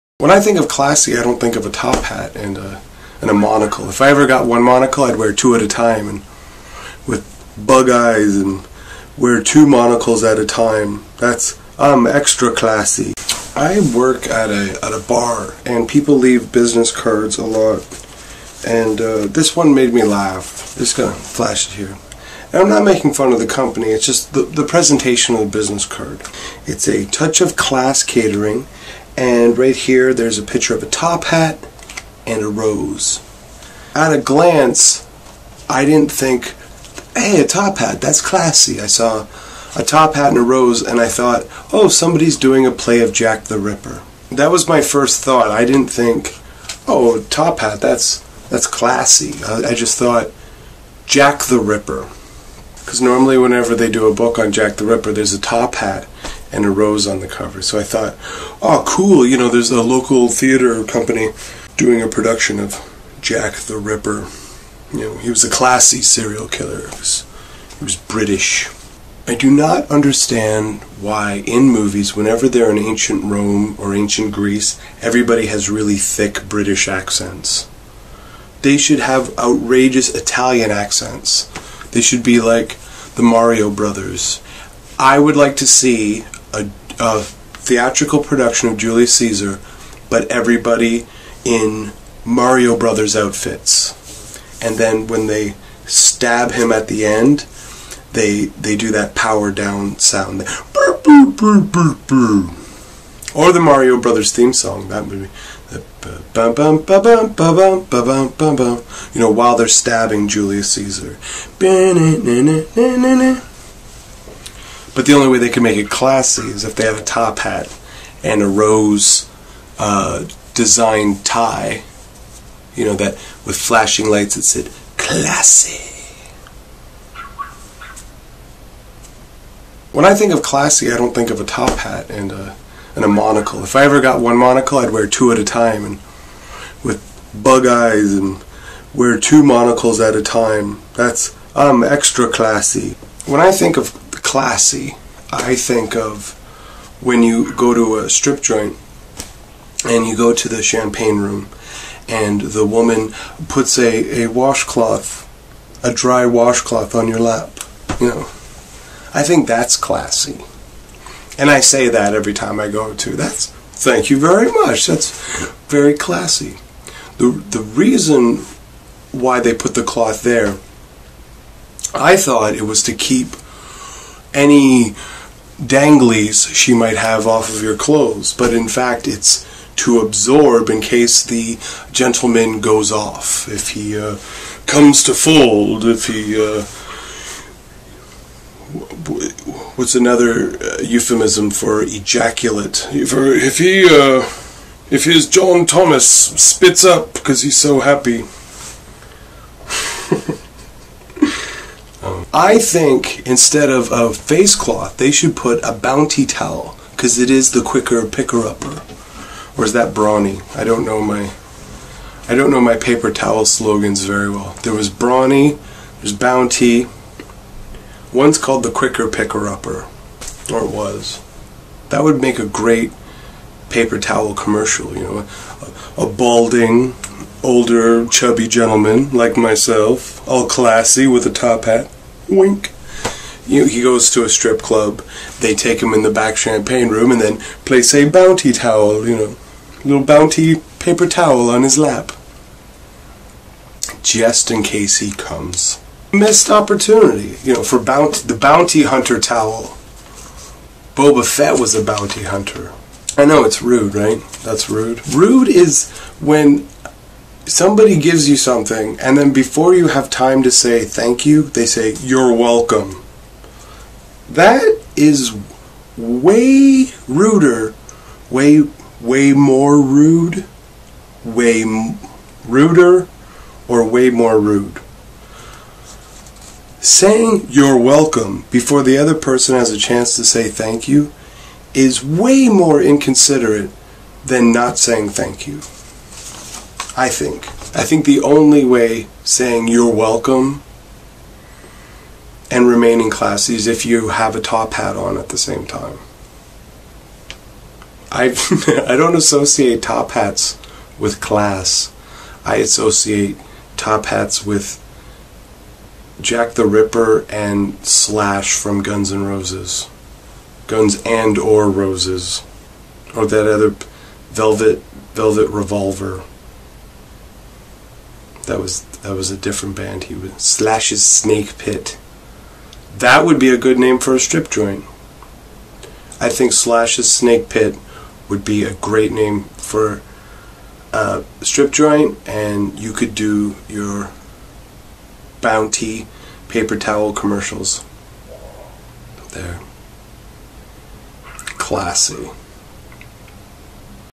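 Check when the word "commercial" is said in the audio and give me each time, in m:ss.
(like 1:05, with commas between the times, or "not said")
3:44, 5:37.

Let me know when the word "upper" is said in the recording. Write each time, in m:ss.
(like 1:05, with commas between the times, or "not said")
3:28, 3:39.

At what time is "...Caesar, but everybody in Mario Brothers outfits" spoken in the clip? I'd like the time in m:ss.
1:29.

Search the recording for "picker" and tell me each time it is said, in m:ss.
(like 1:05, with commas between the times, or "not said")
3:28, 3:39.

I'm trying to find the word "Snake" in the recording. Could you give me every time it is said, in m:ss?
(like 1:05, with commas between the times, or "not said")
5:21, 5:27.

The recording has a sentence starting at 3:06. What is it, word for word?
Uh, what's another uh, euphemism for ejaculate?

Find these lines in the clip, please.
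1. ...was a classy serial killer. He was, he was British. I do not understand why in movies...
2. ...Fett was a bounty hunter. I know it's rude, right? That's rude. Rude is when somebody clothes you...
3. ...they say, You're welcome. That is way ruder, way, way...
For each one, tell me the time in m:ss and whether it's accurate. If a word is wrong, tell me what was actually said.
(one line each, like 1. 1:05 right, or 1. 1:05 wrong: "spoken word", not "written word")
1. 1:05 right
2. 4:11 wrong: "gives", not "clothes"
3. 4:21 right.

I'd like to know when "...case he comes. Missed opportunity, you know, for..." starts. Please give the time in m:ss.
4:04.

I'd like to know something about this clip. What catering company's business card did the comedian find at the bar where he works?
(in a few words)
A Touch of Class Catering.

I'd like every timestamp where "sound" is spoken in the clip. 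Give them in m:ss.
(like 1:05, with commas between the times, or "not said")
1:39.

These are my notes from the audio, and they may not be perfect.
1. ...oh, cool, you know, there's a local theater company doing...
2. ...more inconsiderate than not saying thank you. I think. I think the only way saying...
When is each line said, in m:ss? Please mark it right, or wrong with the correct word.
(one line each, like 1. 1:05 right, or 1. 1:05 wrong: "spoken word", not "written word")
1. 0:58 right
2. 4:42 right.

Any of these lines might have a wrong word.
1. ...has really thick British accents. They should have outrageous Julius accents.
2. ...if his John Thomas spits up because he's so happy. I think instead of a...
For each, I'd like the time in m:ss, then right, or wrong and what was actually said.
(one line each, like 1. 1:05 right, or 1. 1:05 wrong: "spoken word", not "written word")
1. 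1:15 wrong: "Italian", not "Julius"
2. 3:14 right.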